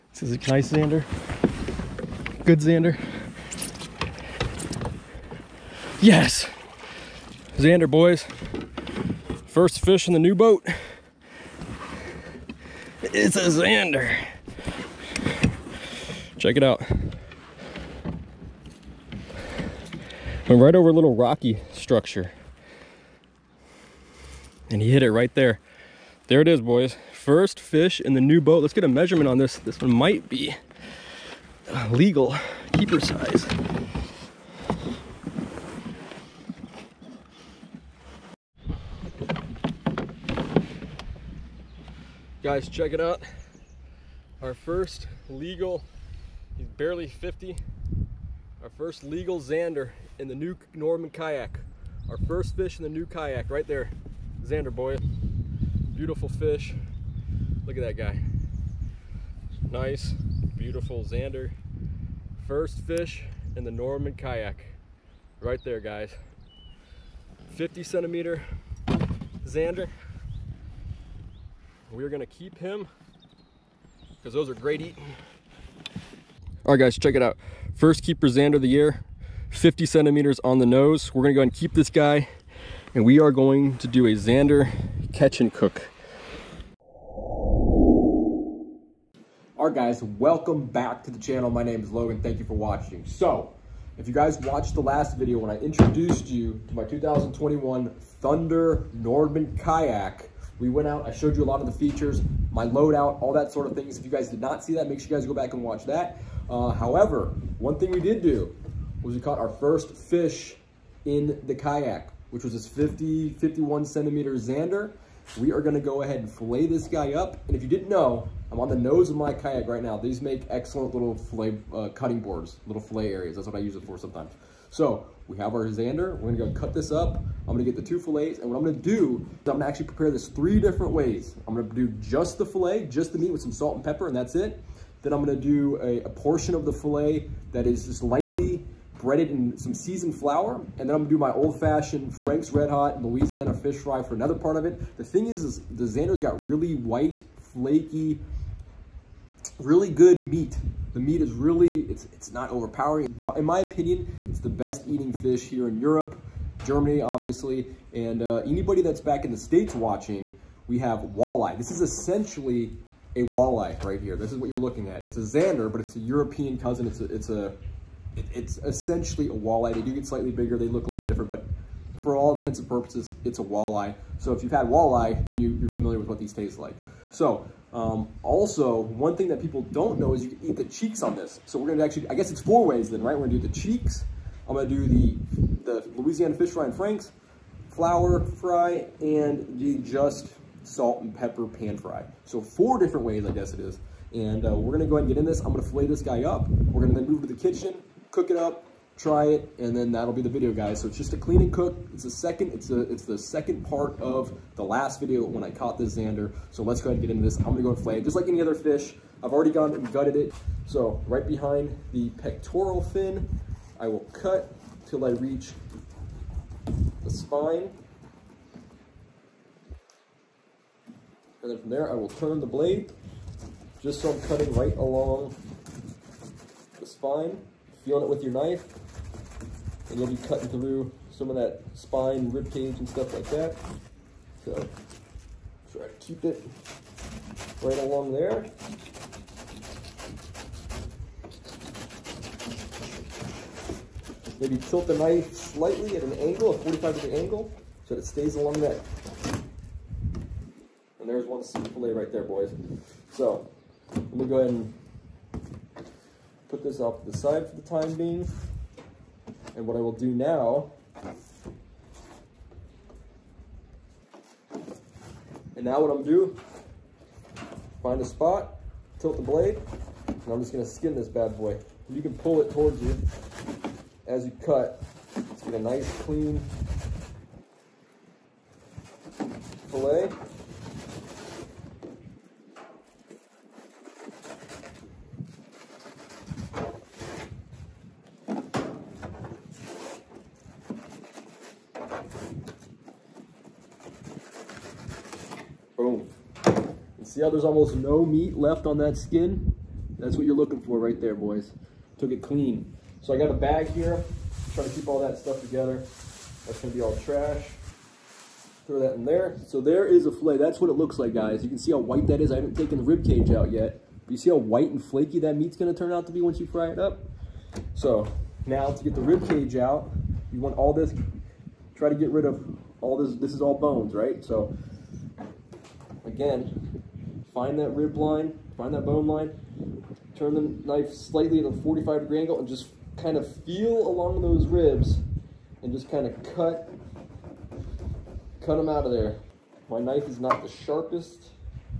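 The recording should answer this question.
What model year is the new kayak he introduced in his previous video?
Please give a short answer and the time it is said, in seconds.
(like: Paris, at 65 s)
2021, at 96 s.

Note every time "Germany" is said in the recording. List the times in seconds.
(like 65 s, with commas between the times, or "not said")
156 s.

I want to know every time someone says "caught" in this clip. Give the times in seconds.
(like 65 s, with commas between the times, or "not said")
109 s, 205 s.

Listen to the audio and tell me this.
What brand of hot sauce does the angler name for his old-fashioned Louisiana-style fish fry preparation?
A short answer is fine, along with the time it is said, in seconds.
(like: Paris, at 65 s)
Frank's Red Hot, at 142 s.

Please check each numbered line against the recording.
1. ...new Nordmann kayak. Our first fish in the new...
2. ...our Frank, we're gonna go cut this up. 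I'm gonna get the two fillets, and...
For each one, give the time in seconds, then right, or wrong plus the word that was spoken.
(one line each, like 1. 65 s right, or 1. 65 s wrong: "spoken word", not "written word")
1. 50 s right
2. 125 s wrong: "Zander", not "Frank".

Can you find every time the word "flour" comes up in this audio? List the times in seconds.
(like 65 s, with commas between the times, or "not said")
140 s, 187 s.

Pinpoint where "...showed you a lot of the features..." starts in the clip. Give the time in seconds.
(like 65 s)
101 s.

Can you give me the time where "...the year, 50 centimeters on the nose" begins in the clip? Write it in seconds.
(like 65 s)
78 s.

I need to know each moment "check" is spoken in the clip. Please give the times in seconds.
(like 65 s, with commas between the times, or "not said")
16 s, 42 s, 76 s.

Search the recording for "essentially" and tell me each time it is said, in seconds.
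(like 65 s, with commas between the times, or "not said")
161 s, 168 s.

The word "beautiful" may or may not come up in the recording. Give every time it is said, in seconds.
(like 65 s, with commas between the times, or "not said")
55 s, 60 s.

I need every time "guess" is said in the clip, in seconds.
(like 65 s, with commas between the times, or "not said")
182 s, 193 s.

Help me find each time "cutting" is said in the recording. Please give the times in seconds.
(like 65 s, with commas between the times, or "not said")
121 s, 224 s, 230 s.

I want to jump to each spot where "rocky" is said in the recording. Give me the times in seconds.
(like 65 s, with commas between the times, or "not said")
21 s.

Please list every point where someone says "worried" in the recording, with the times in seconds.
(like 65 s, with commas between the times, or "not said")
not said.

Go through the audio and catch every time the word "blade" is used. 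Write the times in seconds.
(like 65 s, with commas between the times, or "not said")
222 s, 269 s.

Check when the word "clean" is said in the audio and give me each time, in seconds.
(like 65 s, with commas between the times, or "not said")
201 s, 276 s, 302 s.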